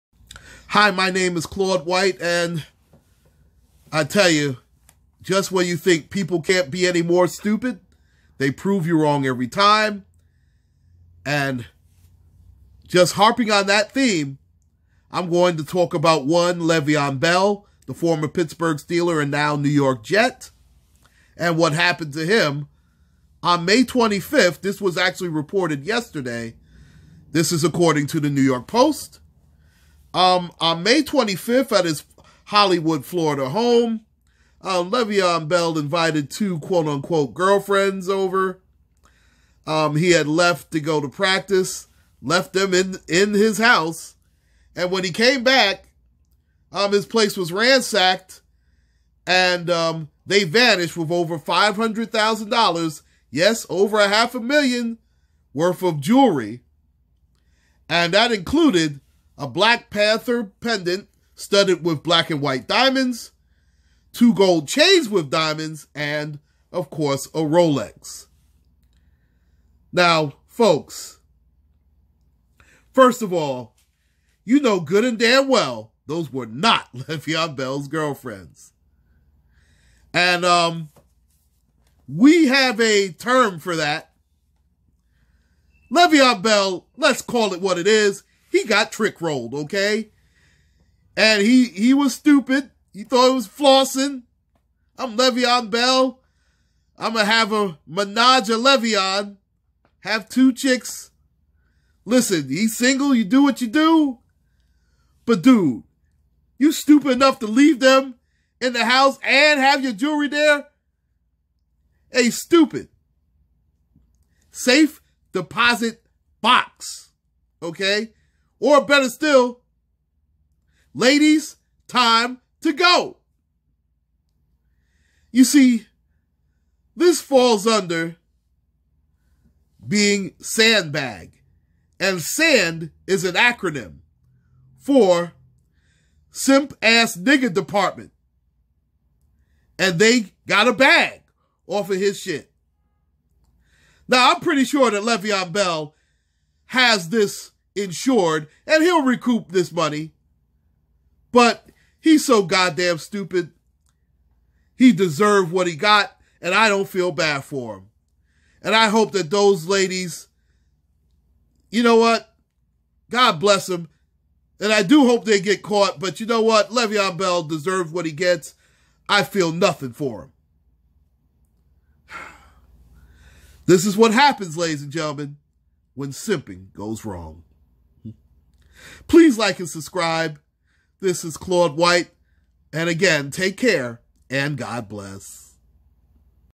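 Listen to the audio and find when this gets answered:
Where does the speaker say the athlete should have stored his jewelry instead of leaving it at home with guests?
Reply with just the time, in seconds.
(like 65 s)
114 s.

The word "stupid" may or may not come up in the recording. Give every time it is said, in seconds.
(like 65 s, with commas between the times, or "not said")
7 s, 92 s, 106 s, 112 s, 152 s.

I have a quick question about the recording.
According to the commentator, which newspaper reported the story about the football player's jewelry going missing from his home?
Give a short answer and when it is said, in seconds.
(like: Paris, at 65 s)
New York Post, at 28 s.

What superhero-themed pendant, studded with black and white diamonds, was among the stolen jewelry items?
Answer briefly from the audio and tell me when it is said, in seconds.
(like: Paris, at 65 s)
Black Panther, at 59 s.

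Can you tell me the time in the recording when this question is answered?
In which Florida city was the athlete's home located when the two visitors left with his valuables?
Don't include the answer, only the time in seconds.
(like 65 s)
32 s.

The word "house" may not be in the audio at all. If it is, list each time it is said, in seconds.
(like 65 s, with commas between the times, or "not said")
43 s, 108 s.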